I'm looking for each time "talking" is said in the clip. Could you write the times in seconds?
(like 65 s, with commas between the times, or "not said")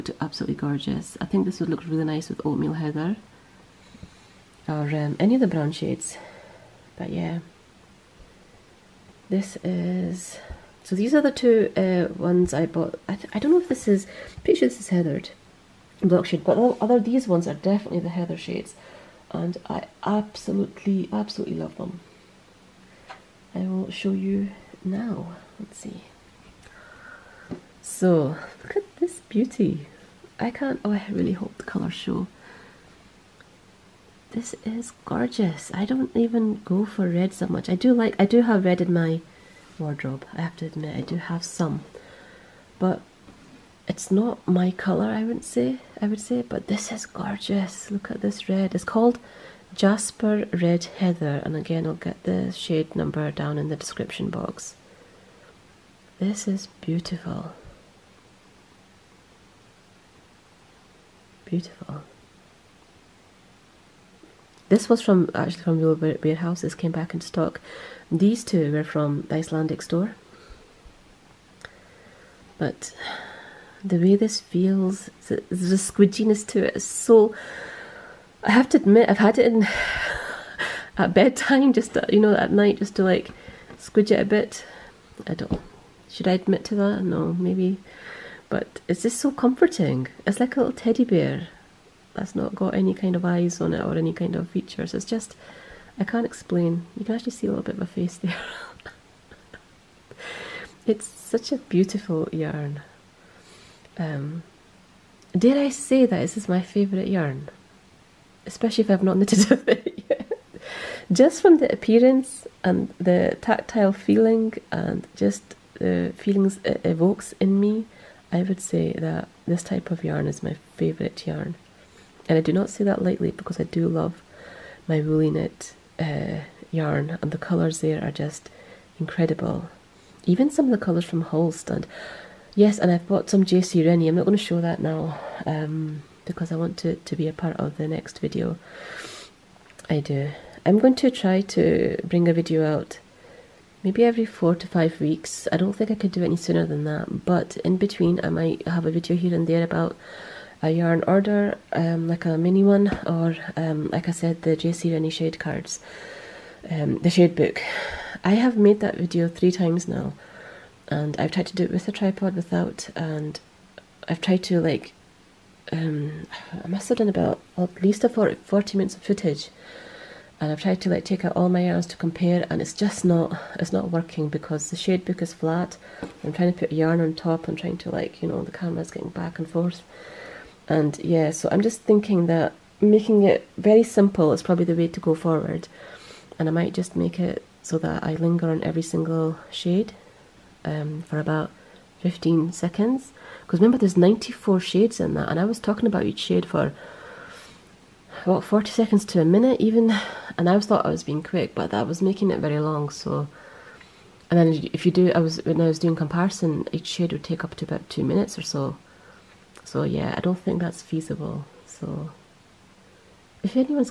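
195 s.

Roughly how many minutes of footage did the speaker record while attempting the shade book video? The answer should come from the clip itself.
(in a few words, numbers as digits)
40 minutes.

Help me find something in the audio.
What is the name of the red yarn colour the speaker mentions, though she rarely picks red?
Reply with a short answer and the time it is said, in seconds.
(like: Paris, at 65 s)
Jasper Red Heather, at 49 s.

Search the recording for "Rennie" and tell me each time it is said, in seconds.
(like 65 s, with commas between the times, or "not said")
133 s, 154 s.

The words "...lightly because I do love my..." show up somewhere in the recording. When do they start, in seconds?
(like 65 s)
123 s.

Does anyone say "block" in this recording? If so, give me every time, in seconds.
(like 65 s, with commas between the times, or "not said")
16 s.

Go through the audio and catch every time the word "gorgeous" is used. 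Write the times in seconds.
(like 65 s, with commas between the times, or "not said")
0 s, 35 s, 47 s.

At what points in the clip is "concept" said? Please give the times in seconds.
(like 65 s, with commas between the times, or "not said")
not said.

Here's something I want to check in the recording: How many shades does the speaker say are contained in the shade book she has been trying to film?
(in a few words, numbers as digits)
94.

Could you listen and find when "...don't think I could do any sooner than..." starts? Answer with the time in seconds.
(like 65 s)
145 s.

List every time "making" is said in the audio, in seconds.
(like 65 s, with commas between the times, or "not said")
182 s, 202 s.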